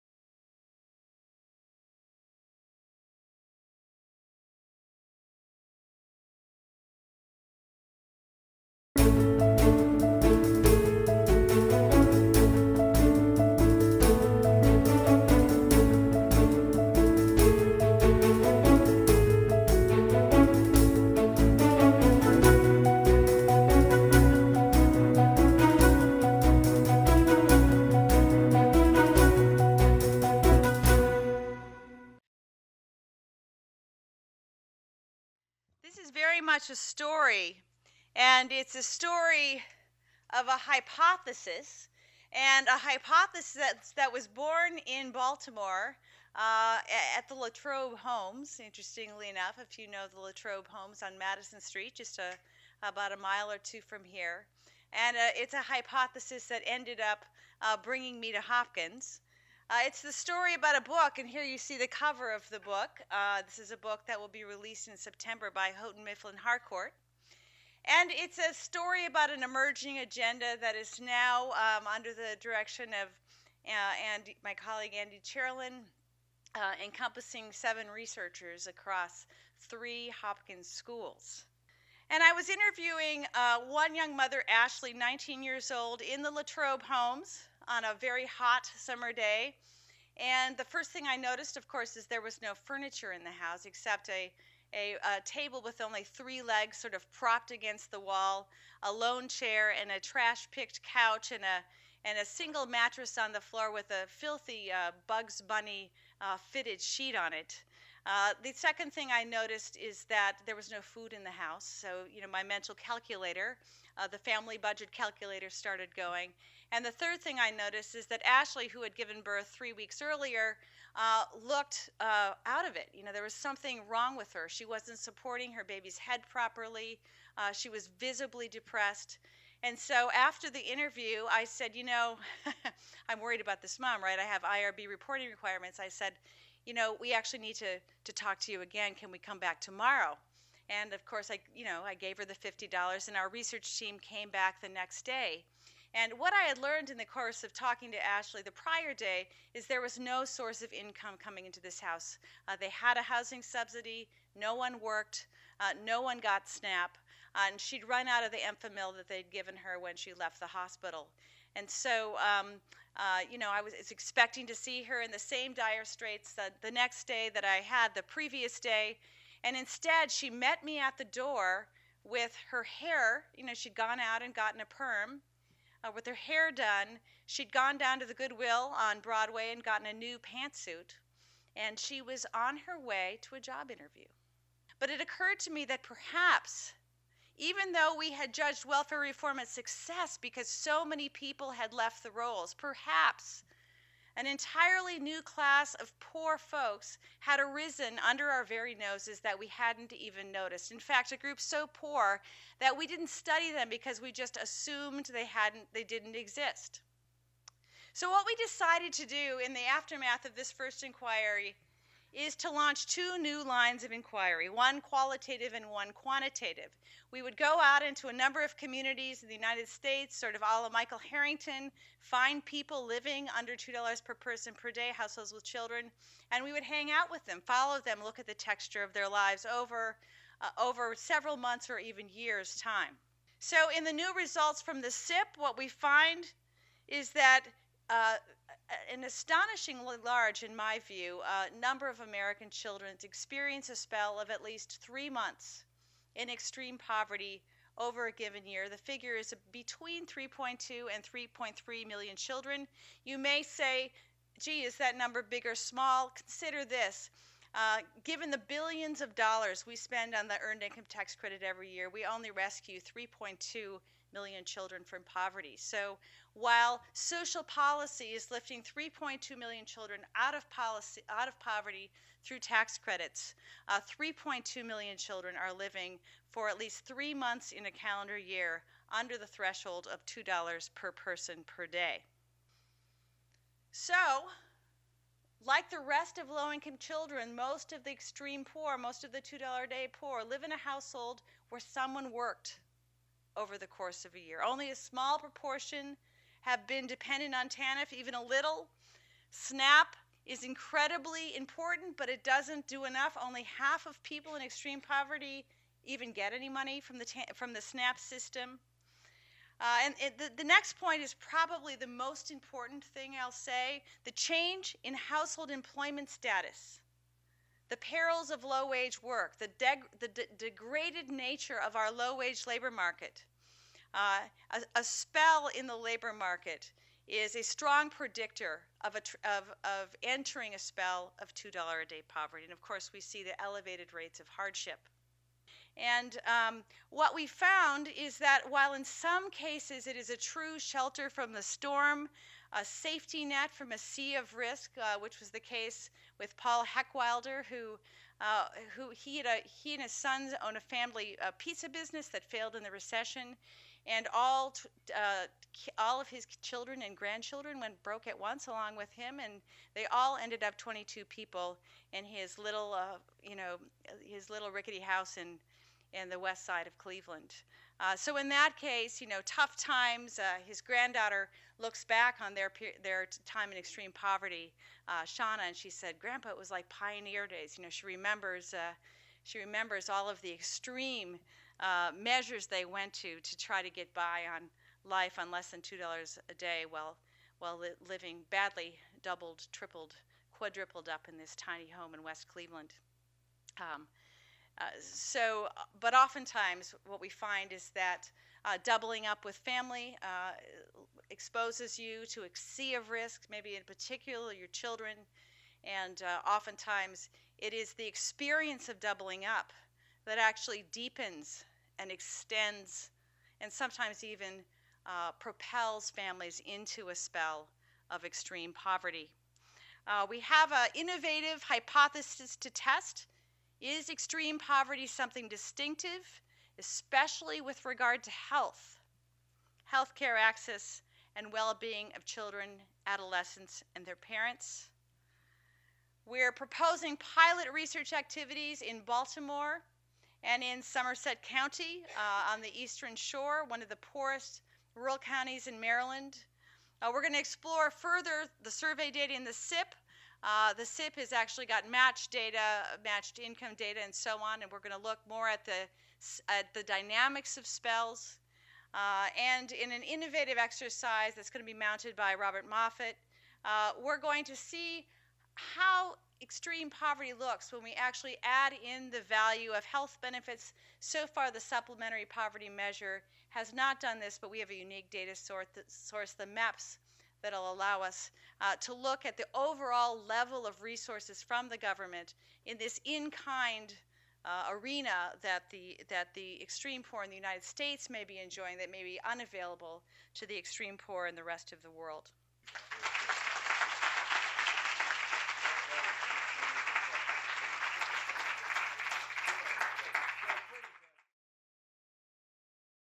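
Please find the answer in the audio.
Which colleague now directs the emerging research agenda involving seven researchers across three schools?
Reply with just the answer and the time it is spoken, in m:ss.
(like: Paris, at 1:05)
Andy Cherlin, at 1:14.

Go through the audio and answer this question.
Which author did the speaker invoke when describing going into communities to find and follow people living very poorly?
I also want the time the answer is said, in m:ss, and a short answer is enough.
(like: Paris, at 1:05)
Michael Harrington, at 3:40.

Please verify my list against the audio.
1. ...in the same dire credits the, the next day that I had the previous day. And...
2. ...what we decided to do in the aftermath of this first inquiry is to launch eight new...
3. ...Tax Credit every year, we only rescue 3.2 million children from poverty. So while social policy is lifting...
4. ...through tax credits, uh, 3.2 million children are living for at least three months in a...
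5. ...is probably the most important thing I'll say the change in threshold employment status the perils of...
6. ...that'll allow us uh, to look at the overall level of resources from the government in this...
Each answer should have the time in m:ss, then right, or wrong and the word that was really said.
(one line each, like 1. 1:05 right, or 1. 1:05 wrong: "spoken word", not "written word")
1. 2:45 wrong: "straits", not "credits"
2. 3:28 wrong: "two", not "eight"
3. 4:20 right
4. 4:32 right
5. 5:11 wrong: "household", not "threshold"
6. 7:57 right.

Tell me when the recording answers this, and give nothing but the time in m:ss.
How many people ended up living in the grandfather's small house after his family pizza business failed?
6:00.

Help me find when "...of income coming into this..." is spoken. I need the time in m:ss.
2:30.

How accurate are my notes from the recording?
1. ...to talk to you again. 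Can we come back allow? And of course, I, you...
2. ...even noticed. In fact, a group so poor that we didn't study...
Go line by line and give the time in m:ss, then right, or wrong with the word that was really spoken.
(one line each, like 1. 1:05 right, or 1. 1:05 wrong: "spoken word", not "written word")
1. 2:18 wrong: "tomorrow", not "allow"
2. 3:19 right.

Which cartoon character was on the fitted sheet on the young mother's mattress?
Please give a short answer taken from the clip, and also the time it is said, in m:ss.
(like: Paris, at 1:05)
Bugs Bunny, at 1:45.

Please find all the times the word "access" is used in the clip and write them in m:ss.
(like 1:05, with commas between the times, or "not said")
7:10.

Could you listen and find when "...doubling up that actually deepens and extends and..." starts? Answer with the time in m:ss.
6:48.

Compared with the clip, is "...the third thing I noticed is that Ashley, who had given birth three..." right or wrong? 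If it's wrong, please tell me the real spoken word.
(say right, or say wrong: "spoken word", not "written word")
right.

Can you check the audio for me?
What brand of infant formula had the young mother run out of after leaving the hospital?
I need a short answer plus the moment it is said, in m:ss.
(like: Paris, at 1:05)
Enfamil, at 2:38.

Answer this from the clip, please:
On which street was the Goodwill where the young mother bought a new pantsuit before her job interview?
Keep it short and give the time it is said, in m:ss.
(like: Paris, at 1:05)
Broadway, at 2:59.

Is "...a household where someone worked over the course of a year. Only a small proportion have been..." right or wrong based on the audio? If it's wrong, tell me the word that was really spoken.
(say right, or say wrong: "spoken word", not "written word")
right.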